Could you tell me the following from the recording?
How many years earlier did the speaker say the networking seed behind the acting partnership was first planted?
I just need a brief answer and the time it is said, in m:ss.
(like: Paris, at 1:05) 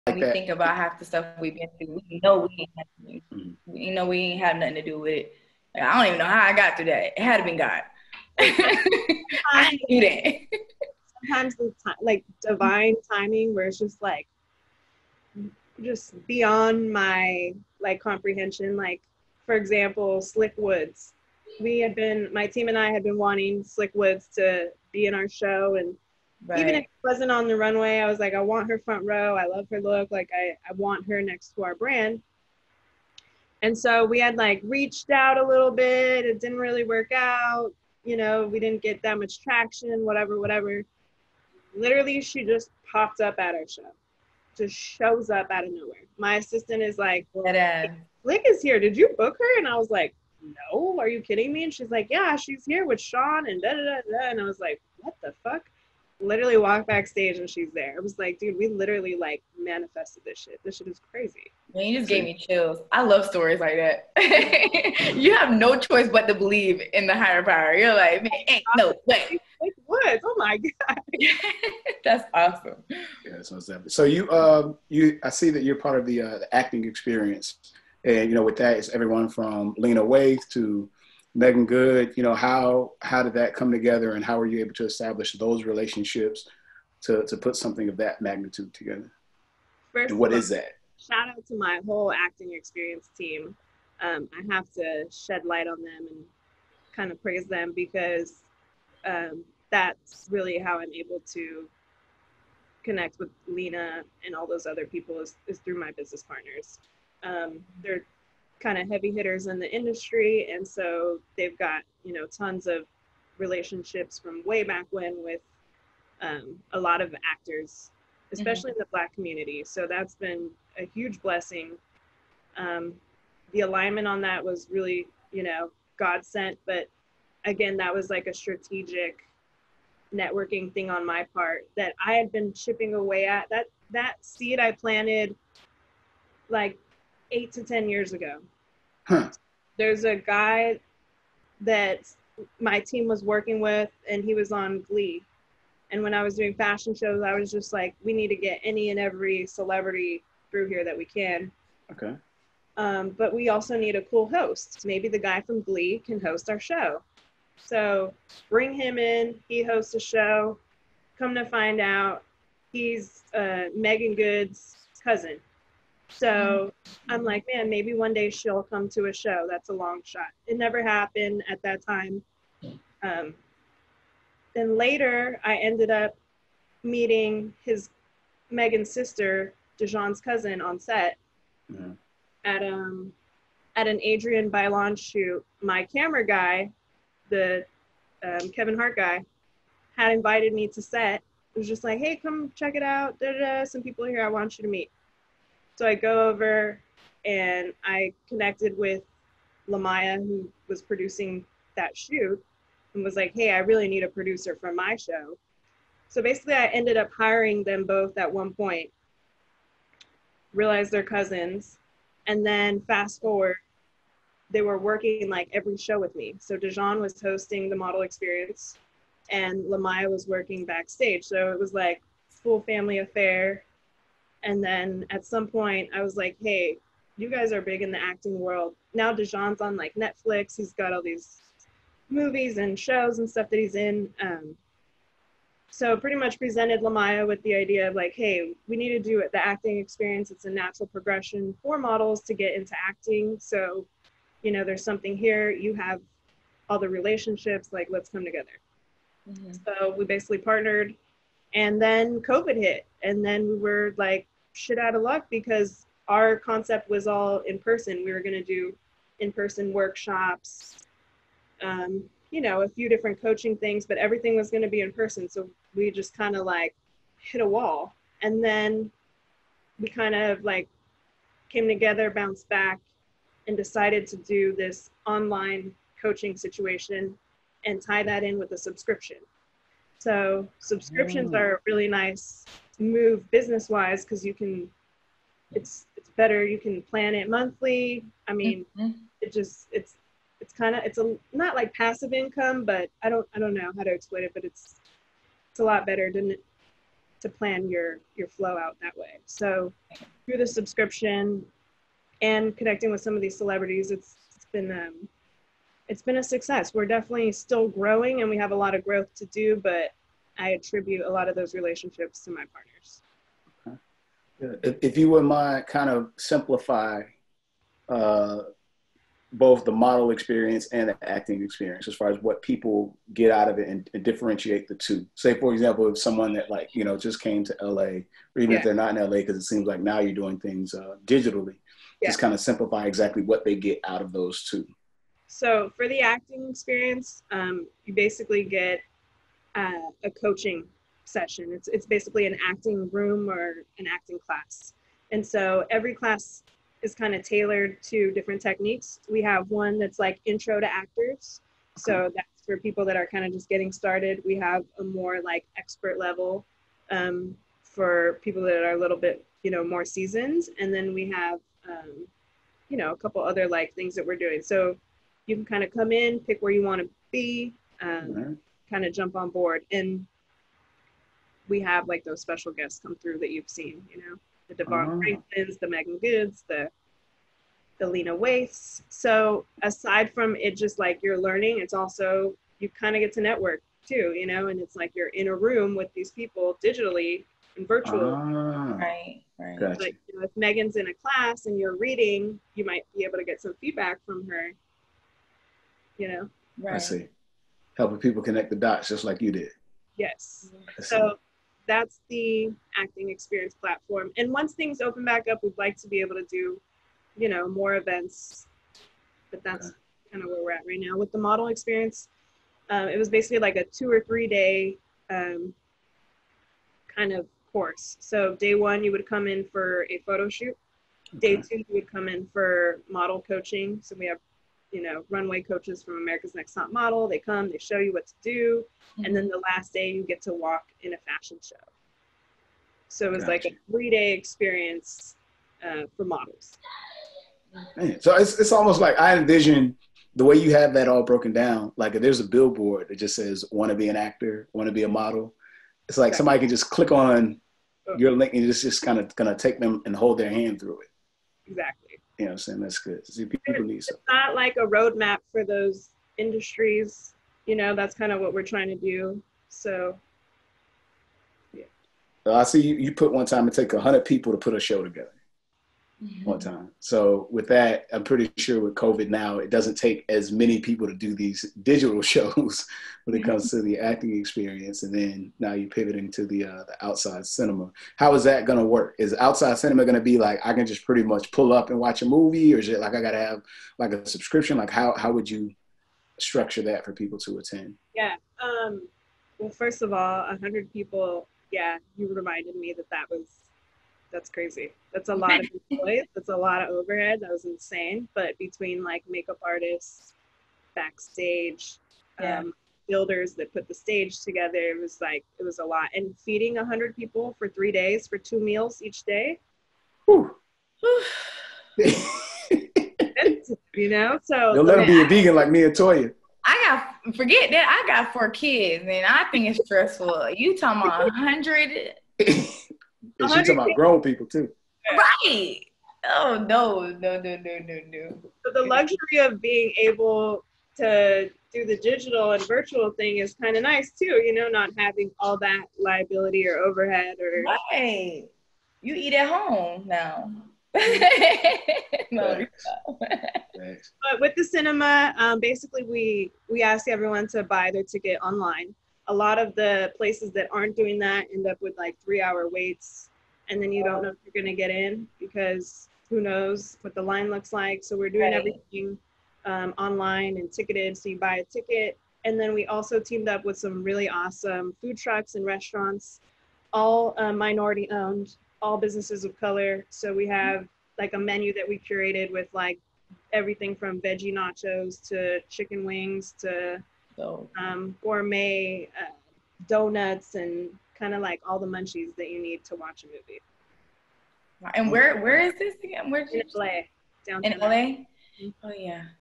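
8 to 10, at 2:17.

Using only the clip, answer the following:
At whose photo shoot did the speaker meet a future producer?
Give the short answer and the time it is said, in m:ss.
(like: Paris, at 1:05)
Adrienne Bailon, at 3:04.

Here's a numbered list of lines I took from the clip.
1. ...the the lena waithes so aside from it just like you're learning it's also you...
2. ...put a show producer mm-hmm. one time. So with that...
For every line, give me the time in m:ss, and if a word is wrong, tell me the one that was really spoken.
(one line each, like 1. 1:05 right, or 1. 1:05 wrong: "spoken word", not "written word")
1. 6:16 right
2. 7:44 wrong: "together", not "producer".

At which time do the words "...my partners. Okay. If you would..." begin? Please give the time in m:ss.
5:12.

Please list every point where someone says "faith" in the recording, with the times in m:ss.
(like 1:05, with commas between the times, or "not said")
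not said.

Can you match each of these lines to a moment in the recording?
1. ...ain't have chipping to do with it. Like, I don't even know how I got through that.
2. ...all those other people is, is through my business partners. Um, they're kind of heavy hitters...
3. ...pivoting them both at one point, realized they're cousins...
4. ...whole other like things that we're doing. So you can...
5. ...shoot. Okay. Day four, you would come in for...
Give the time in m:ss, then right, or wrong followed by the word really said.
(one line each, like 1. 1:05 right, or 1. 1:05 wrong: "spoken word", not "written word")
1. 0:04 wrong: "nothing", not "chipping"
2. 1:44 right
3. 3:27 wrong: "hiring", not "pivoting"
4. 6:02 wrong: "couple", not "whole"
5. 7:00 wrong: "two", not "four".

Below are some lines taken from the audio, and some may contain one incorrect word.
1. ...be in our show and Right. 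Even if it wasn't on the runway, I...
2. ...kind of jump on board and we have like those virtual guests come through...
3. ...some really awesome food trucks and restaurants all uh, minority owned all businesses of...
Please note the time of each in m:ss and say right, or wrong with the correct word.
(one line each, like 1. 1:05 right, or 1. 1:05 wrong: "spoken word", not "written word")
1. 0:24 right
2. 6:08 wrong: "special", not "virtual"
3. 9:23 right.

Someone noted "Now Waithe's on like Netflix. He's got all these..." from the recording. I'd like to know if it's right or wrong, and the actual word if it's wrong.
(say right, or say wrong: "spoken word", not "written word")
wrong: "Dijon", not "Waithe".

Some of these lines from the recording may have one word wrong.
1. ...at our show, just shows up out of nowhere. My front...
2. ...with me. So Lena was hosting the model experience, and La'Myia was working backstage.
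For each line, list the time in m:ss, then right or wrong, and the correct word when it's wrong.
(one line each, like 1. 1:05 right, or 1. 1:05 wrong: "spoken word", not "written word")
1. 0:43 wrong: "assistant", not "front"
2. 3:35 wrong: "Dijon", not "Lena".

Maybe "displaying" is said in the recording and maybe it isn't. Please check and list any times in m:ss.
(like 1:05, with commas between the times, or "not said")
not said.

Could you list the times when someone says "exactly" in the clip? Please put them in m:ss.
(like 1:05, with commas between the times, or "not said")
5:32, 7:26, 7:31.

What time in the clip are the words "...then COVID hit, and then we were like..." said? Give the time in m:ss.
4:11.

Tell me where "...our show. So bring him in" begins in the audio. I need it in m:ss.
2:36.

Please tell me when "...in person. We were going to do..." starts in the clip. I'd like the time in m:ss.
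4:17.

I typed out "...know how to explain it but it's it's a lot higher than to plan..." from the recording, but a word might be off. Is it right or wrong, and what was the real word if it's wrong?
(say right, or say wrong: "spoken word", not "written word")
wrong: "better", not "higher".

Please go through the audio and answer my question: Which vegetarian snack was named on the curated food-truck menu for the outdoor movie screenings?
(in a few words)
veggie nachos.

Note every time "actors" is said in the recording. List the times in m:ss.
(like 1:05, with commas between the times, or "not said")
1:57, 5:50, 7:23.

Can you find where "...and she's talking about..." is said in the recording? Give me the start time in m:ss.
8:43.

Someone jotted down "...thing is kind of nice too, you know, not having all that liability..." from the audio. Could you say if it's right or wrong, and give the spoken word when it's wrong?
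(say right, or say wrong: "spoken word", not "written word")
right.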